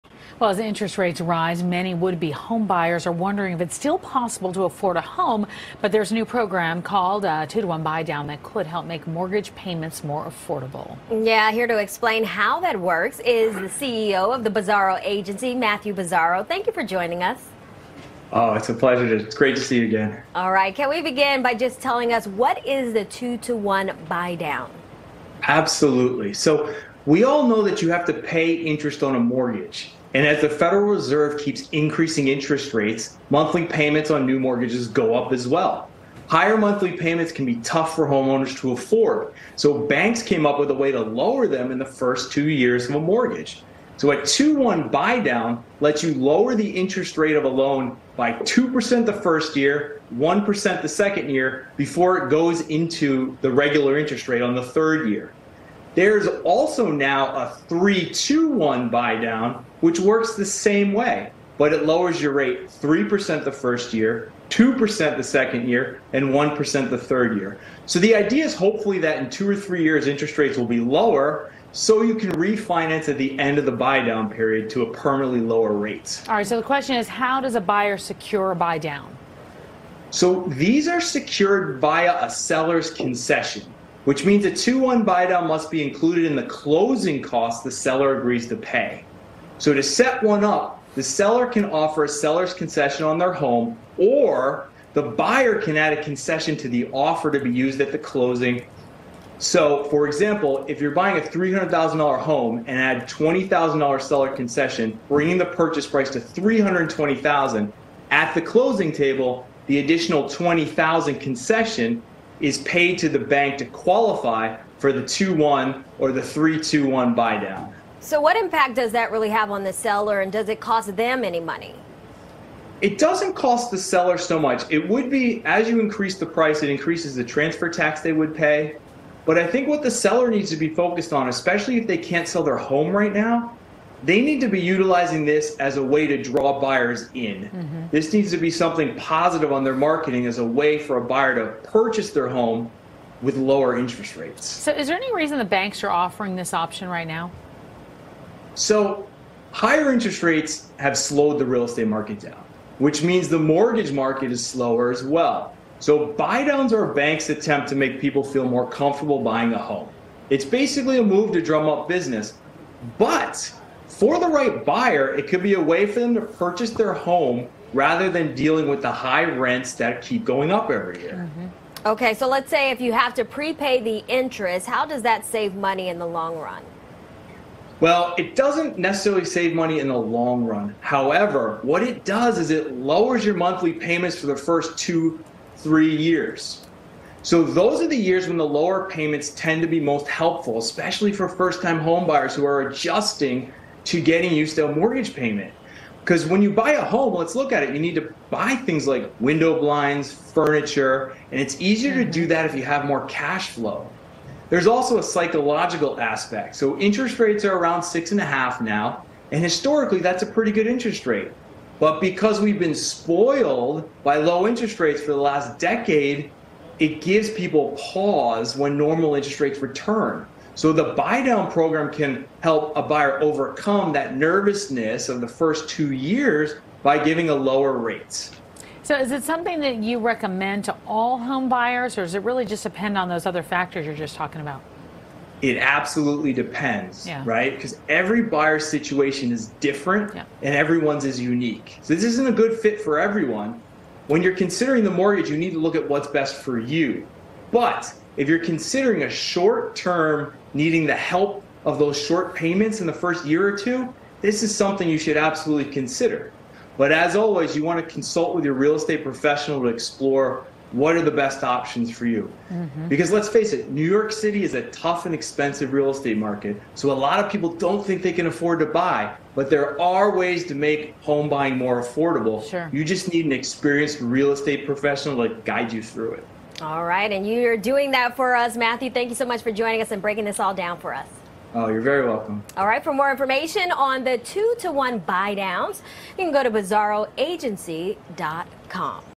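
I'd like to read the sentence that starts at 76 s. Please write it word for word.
All right, so the question is how does a buyer secure a buy down?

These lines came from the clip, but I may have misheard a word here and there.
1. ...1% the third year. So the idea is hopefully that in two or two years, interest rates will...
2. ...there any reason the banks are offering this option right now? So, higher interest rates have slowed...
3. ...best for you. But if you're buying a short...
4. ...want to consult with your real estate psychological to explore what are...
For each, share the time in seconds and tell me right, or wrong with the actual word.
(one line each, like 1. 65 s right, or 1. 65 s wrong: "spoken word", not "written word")
1. 66 s wrong: "three", not "two"
2. 144 s right
3. 246 s wrong: "considering", not "buying"
4. 257 s wrong: "professional", not "psychological".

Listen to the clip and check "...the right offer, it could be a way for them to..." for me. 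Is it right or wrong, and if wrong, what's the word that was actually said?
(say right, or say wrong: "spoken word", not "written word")
wrong: "buyer", not "offer".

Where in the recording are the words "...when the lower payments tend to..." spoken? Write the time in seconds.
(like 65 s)
188 s.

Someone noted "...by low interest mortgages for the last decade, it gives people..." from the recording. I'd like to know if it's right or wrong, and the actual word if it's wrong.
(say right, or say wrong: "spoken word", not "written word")
wrong: "rates", not "mortgages".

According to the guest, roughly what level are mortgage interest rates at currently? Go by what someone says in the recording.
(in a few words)
6.5%.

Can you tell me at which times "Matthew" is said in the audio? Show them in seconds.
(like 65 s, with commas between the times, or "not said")
15 s, 278 s.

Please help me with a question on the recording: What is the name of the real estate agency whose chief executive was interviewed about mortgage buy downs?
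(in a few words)
Bizzarro Agency.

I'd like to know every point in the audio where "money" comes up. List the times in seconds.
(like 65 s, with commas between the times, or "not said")
121 s, 175 s, 179 s.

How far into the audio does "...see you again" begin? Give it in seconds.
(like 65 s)
19 s.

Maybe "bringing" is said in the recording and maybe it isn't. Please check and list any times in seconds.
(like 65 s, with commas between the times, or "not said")
105 s.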